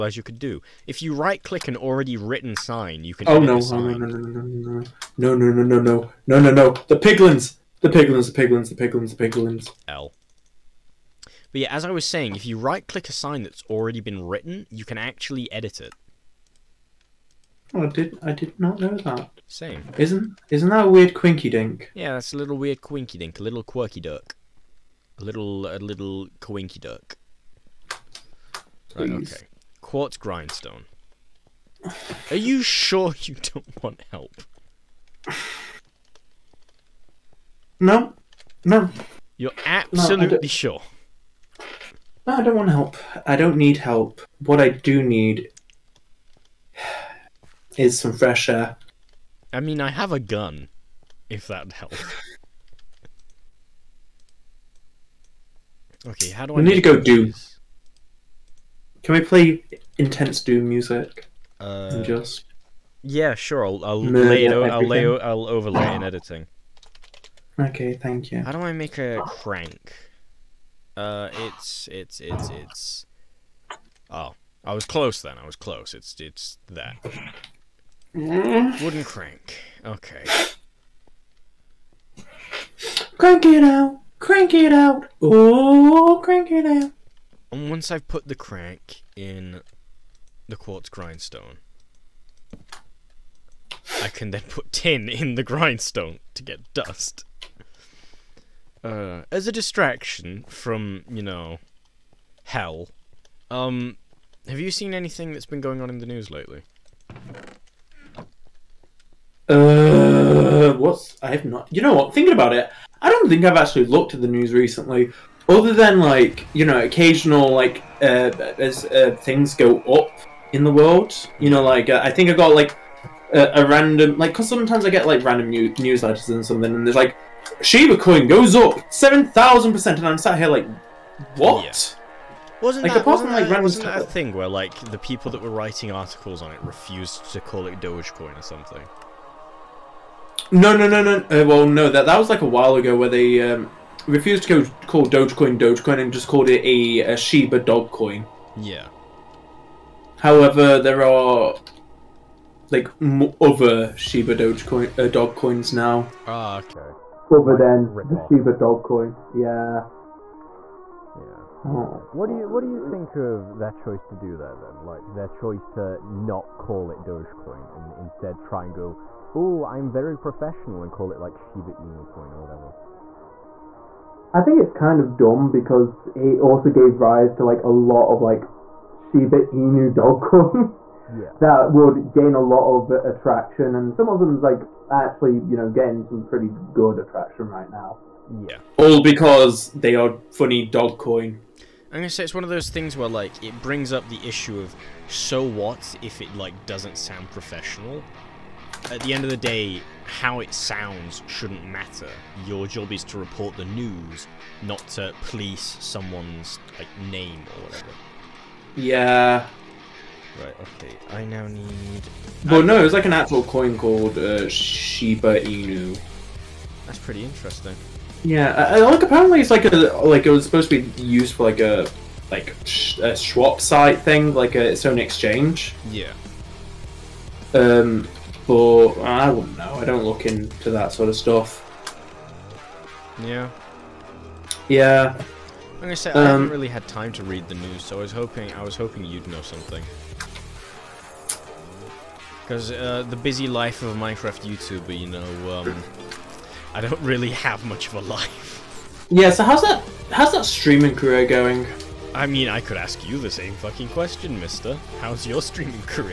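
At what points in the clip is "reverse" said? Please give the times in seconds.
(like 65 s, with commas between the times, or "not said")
not said.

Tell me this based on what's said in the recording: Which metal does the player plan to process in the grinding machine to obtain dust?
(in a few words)
Tin.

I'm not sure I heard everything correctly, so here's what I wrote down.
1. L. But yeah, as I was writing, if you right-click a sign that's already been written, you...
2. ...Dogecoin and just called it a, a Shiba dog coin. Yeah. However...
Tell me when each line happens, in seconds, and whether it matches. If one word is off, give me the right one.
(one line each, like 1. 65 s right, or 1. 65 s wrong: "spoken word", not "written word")
1. 9 s wrong: "saying", not "writing"
2. 145 s right.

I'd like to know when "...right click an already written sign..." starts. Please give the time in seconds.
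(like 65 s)
1 s.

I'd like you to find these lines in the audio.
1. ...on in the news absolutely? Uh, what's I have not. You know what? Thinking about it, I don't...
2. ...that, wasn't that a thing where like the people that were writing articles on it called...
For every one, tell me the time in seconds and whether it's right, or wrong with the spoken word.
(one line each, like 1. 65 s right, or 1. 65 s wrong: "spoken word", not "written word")
1. 105 s wrong: "lately", not "absolutely"
2. 133 s wrong: "refused", not "called".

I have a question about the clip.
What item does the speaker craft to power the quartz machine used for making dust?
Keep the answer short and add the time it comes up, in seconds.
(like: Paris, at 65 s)
Wooden crank, at 78 s.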